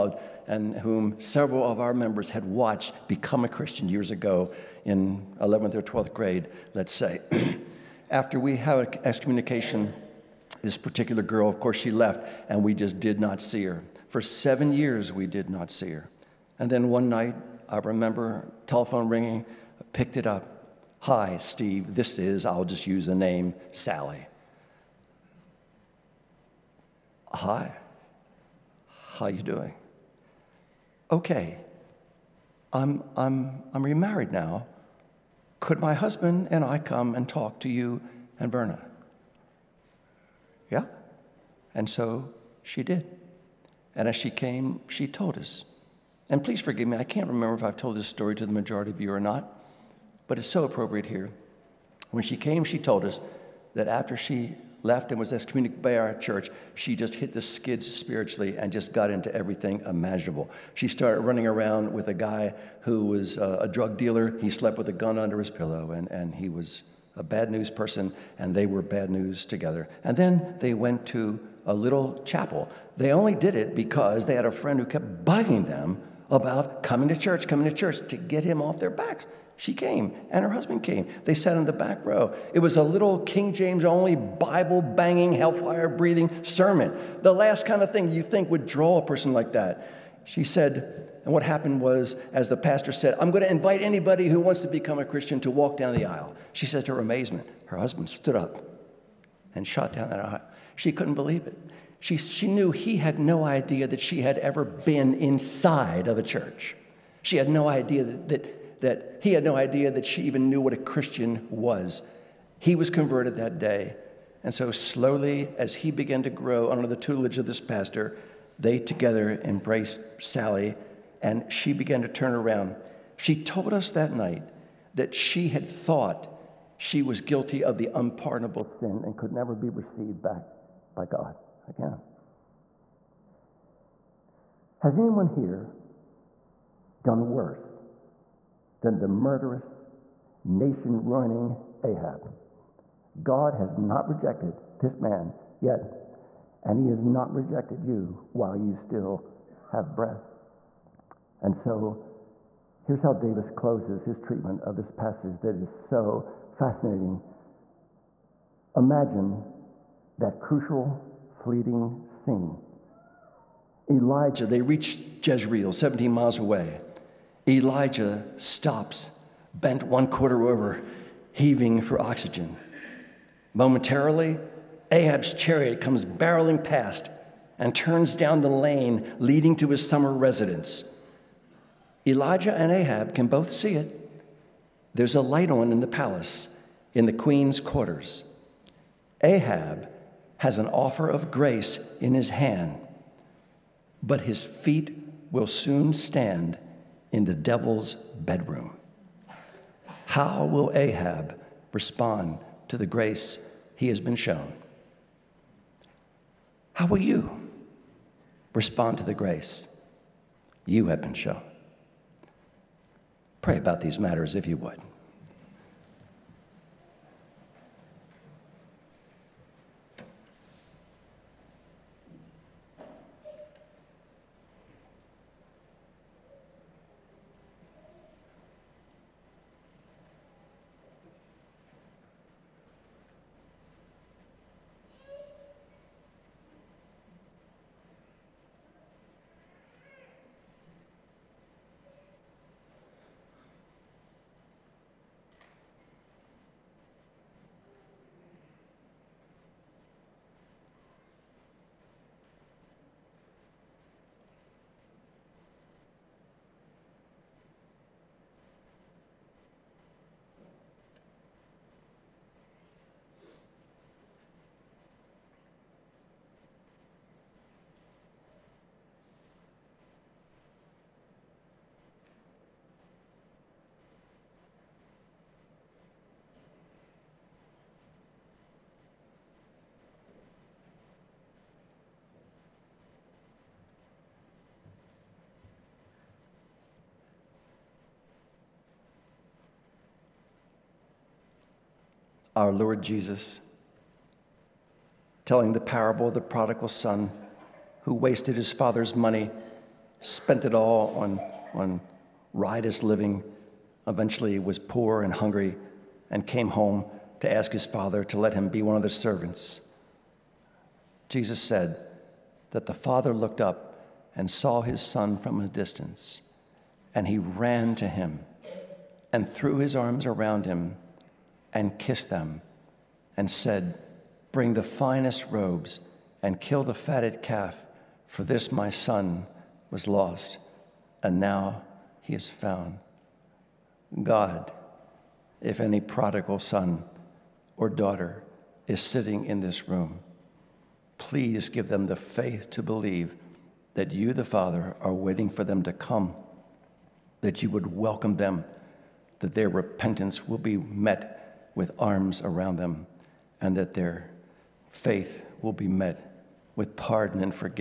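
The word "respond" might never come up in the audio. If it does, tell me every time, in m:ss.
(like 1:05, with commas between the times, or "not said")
3:21, 3:28.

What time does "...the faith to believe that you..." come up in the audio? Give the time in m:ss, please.
5:41.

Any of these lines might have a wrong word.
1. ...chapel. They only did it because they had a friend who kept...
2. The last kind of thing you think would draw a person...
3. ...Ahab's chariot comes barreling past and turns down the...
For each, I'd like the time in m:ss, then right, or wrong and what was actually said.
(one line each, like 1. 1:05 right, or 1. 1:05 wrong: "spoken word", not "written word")
1. 1:12 right
2. 1:27 right
3. 2:54 right.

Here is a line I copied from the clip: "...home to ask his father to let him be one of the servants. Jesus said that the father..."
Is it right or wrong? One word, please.
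right.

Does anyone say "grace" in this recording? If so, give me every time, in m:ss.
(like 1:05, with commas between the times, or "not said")
3:11, 3:22, 3:29.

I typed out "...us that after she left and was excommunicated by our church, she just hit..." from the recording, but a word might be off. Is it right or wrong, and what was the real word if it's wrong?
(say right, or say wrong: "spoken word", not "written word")
right.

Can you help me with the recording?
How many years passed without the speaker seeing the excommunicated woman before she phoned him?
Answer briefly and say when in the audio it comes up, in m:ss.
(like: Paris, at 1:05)
7, at 0:14.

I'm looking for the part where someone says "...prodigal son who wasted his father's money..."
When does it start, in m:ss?
4:56.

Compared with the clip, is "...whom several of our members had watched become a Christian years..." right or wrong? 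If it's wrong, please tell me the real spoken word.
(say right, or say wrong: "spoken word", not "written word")
right.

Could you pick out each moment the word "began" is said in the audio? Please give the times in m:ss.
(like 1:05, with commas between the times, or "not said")
1:55, 2:01.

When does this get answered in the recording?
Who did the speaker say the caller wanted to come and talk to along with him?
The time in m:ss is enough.
0:38.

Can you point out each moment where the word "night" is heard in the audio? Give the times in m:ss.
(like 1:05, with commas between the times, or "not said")
0:17, 2:04.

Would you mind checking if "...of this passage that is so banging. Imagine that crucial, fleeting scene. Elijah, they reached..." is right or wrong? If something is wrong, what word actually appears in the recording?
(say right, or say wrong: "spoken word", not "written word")
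wrong: "fascinating", not "banging".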